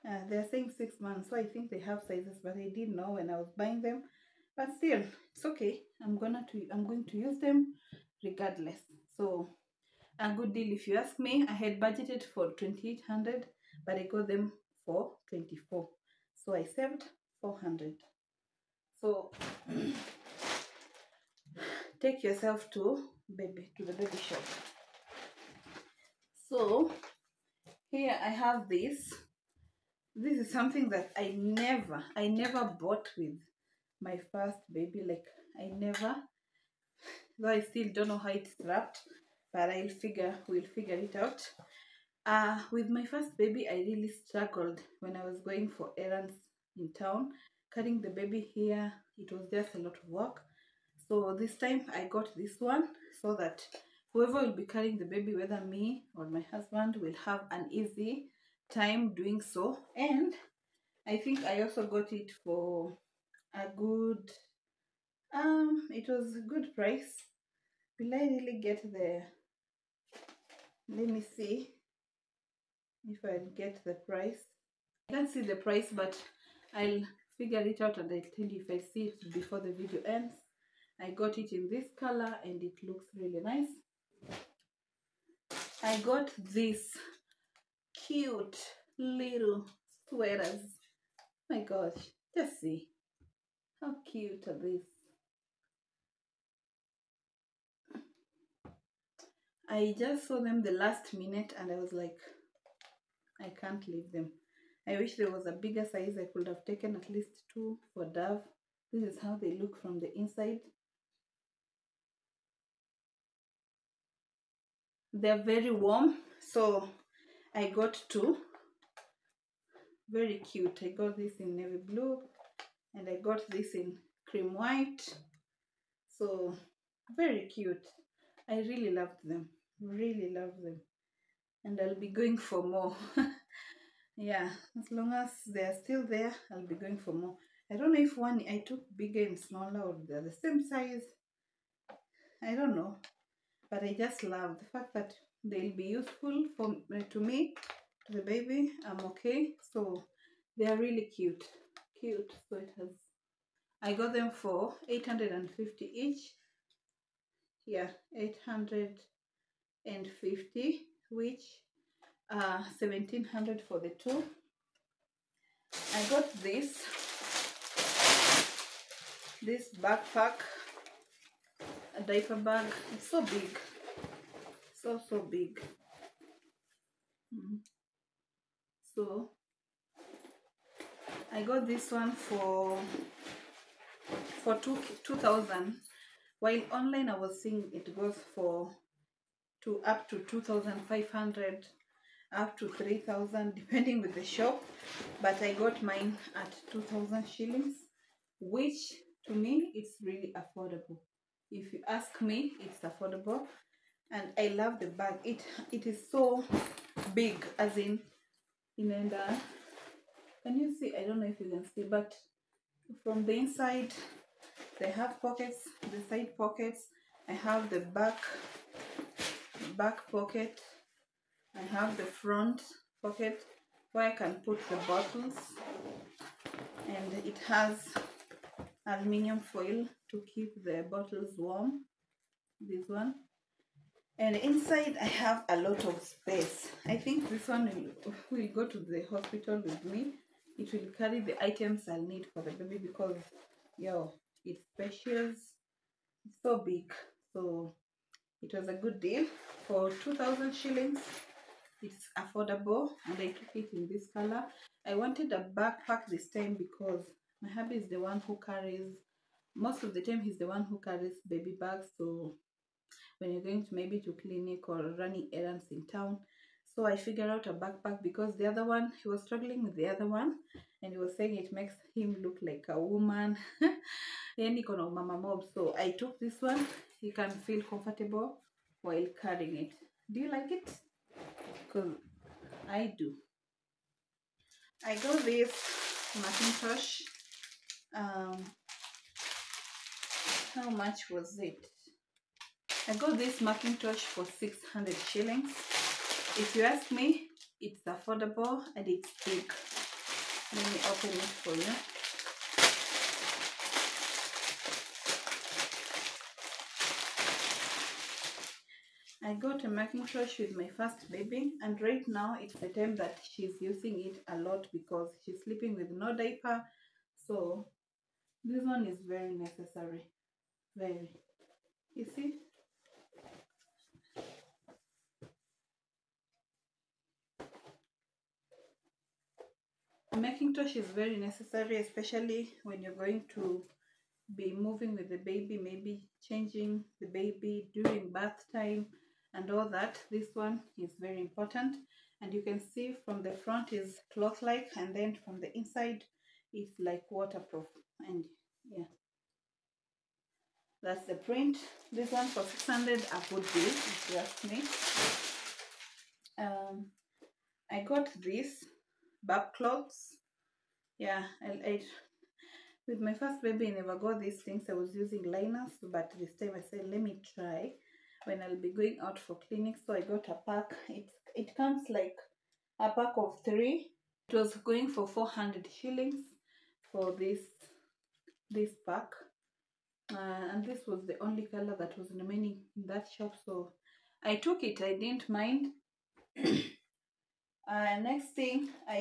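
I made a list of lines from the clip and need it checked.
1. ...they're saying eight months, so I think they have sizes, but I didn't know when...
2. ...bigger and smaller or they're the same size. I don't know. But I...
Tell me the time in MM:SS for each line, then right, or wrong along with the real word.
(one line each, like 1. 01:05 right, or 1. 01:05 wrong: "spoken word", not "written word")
1. 00:00 wrong: "six", not "eight"
2. 02:18 right.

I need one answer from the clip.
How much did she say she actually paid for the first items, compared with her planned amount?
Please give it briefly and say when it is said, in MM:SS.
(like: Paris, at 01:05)
2400, at 00:13.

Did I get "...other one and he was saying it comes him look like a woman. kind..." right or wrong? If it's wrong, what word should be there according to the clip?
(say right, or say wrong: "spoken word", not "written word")
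wrong: "makes", not "comes".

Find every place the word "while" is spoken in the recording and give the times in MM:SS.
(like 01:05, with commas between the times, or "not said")
03:06, 04:38.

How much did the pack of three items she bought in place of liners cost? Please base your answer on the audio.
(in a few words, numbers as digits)
400 shillings.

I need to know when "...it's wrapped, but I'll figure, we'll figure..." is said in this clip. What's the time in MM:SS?
00:38.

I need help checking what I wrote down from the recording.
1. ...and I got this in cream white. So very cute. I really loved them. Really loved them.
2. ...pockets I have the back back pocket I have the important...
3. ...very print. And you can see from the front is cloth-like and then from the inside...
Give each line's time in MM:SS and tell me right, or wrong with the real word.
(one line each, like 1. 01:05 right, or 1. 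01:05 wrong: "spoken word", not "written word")
1. 02:02 right
2. 03:36 wrong: "front", not "important"
3. 05:40 wrong: "important", not "print".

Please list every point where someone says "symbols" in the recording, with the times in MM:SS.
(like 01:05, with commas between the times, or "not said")
not said.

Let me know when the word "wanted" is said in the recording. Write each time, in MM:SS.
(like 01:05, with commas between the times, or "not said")
04:14.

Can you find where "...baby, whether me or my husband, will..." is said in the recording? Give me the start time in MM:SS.
00:55.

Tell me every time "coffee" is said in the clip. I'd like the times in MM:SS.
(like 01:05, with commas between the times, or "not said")
not said.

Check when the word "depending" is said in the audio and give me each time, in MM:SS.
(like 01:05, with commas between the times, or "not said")
03:13.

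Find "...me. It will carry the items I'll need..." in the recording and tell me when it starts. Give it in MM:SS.
03:59.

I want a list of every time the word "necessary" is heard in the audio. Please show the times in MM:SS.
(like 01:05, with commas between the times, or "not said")
05:19, 05:31.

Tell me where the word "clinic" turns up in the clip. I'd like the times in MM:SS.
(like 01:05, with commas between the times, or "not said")
04:24, 06:09.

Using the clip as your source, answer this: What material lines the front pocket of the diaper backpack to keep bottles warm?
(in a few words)
Aluminium foil.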